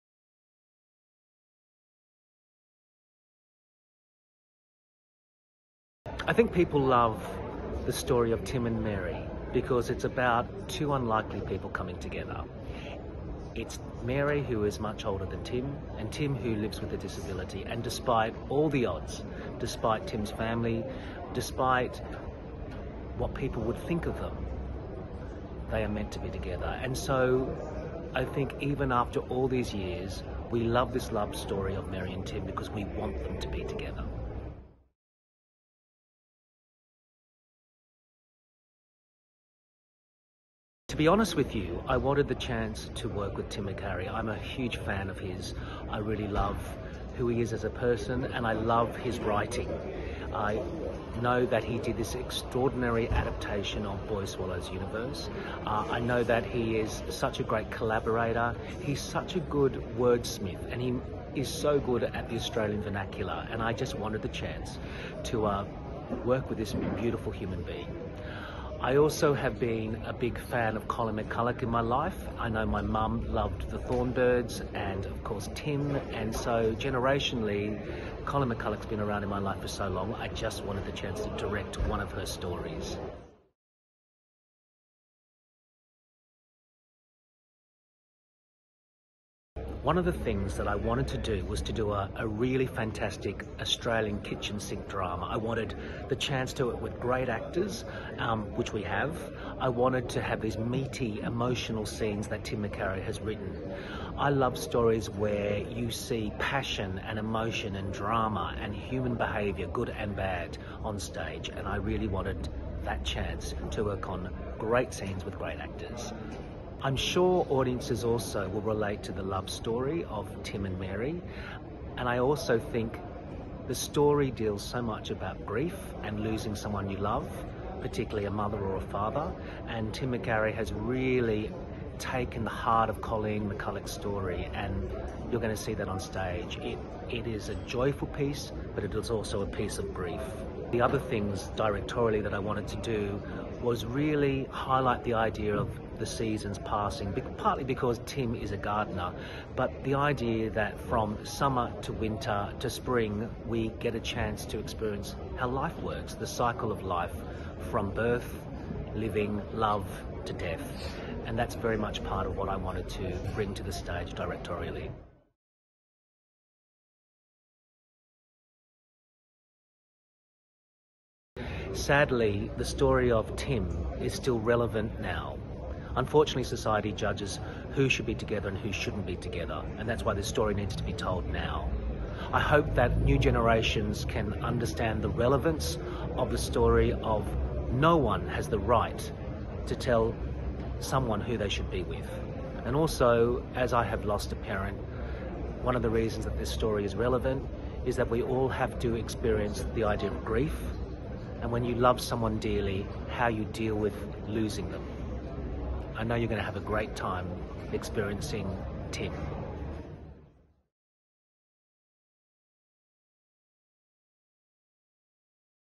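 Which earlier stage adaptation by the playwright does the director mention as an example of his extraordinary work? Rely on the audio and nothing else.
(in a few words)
Boy Swallows Universe.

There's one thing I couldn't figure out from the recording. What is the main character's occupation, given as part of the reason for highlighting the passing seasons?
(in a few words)
Gardener.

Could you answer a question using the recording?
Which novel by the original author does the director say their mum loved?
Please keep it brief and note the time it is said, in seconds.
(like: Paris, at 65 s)
The Thorn Birds, at 73 s.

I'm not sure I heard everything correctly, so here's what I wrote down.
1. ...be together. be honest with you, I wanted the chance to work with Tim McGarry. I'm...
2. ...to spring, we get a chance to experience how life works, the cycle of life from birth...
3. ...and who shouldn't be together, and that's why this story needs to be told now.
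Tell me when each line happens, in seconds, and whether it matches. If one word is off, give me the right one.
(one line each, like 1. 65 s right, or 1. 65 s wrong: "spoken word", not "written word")
1. 33 s right
2. 152 s right
3. 178 s right.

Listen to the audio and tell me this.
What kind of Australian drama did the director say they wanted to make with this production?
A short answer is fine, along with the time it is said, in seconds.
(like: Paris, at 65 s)
Kitchen sink drama, at 94 s.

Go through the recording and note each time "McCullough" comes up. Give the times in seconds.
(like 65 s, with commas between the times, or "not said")
71 s, 78 s, 133 s.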